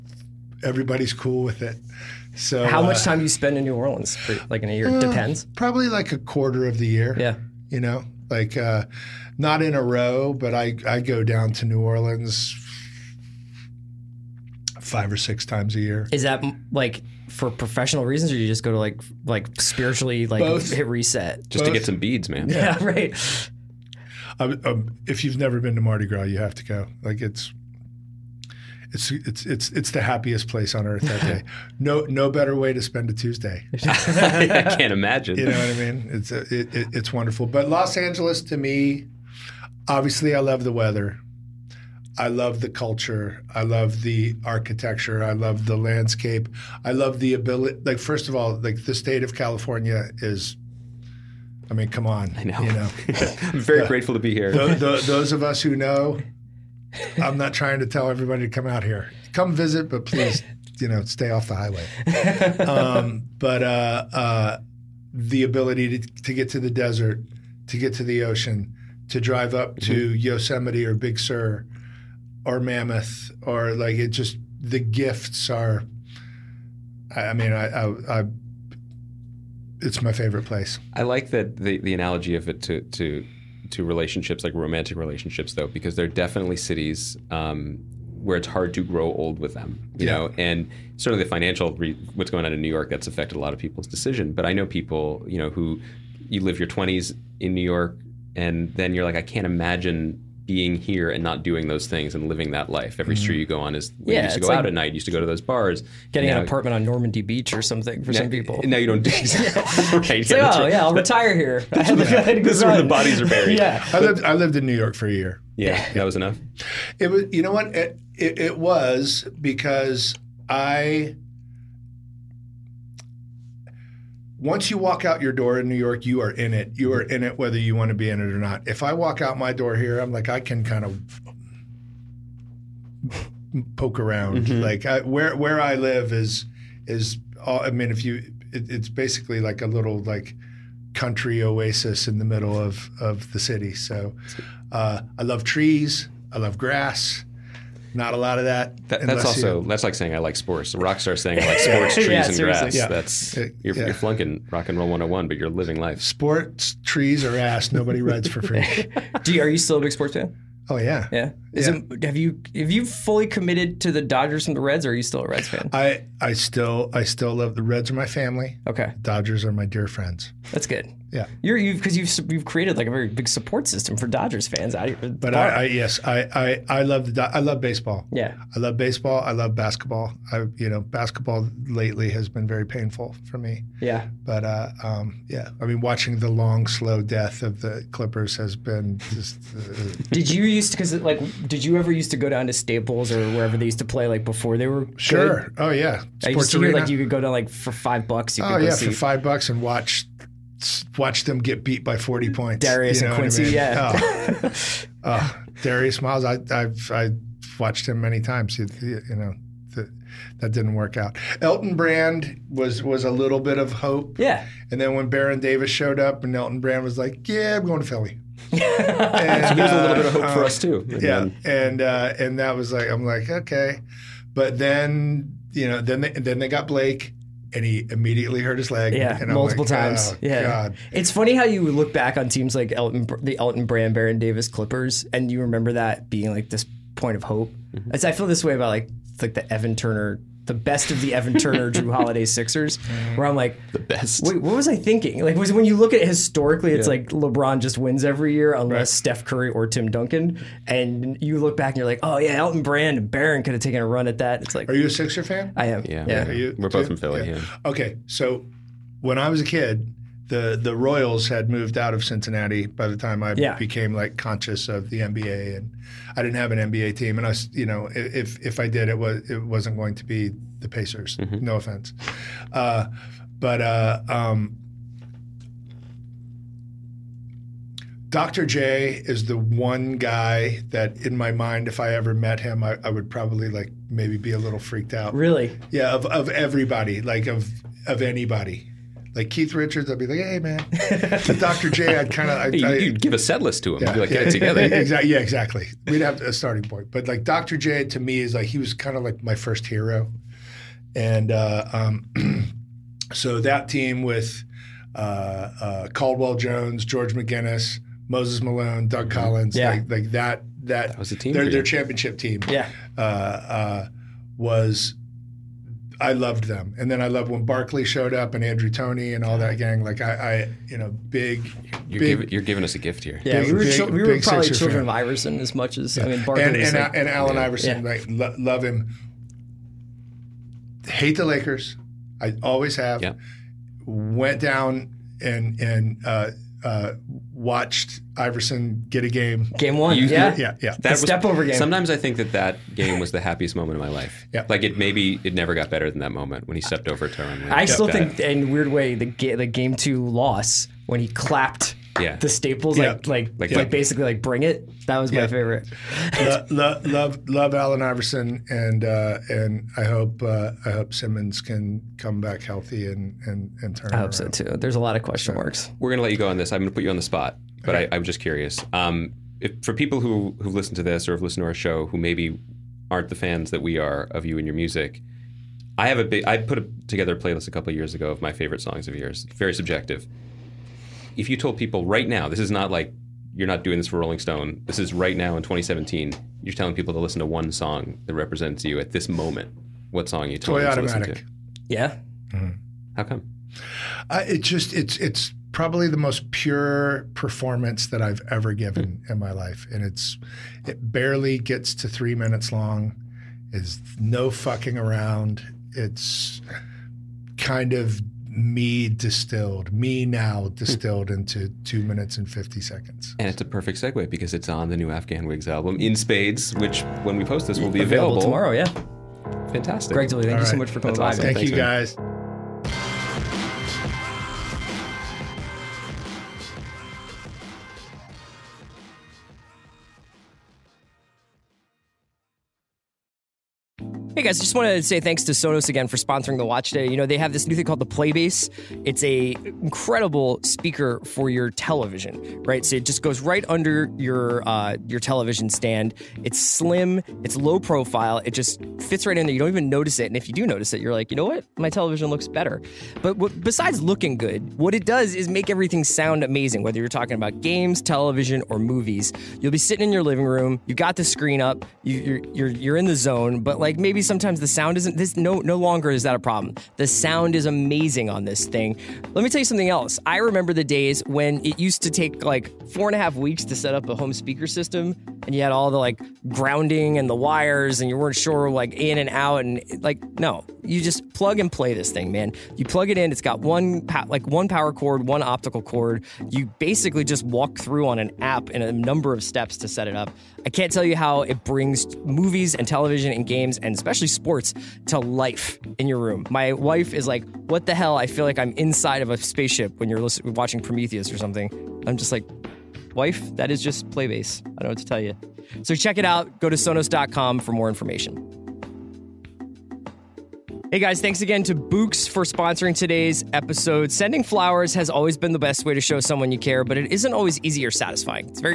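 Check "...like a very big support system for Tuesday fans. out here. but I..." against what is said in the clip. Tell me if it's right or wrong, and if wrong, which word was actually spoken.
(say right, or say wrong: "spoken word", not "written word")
wrong: "Dodgers", not "Tuesday".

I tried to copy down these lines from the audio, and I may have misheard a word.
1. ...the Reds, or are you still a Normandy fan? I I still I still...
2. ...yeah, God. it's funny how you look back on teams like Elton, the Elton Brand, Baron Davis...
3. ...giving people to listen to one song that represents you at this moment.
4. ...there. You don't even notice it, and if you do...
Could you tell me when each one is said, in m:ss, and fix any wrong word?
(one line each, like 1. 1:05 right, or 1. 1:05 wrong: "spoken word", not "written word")
1. 2:44 wrong: "Reds", not "Normandy"
2. 3:50 right
3. 6:26 wrong: "telling", not "giving"
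4. 7:29 right.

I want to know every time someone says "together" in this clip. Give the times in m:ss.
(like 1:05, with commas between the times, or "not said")
4:54, 6:16.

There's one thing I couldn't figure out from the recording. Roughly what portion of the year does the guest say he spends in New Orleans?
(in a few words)
A quarter.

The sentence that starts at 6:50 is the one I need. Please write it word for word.
distilled into two minutes and 50 seconds.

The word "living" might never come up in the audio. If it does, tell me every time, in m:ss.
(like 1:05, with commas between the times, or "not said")
1:42, 2:35, 7:40.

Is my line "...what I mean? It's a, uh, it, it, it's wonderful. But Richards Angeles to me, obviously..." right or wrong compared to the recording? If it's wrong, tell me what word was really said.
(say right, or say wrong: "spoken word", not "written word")
wrong: "Los", not "Richards".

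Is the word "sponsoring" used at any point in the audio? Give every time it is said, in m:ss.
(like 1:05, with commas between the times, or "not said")
7:15, 8:32.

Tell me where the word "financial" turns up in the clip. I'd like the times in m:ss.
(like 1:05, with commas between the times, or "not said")
1:31.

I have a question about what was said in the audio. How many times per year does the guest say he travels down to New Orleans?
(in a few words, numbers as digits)
5 or 6.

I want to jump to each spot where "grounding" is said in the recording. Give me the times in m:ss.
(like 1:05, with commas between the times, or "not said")
7:56.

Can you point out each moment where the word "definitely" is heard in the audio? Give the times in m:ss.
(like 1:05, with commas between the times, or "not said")
1:26.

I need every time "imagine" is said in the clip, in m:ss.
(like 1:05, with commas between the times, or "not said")
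0:34, 1:39.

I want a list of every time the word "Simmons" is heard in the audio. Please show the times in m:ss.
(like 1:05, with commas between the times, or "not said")
6:00.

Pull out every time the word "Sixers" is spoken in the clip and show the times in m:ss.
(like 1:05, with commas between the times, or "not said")
4:02, 4:14.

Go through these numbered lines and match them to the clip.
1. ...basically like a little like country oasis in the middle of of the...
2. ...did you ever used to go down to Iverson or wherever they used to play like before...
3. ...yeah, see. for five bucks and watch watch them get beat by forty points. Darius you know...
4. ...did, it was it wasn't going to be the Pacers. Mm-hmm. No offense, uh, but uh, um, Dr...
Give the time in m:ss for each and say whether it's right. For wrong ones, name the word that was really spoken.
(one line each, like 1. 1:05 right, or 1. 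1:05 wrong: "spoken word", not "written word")
1. 2:18 right
2. 3:11 wrong: "Staples", not "Iverson"
3. 3:18 right
4. 4:28 right.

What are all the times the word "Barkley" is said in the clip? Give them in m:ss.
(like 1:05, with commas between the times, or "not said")
5:17, 5:26.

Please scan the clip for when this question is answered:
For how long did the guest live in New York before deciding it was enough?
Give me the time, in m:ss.
1:54.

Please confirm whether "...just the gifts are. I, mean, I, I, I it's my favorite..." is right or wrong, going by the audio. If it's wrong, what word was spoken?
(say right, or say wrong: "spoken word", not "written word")
right.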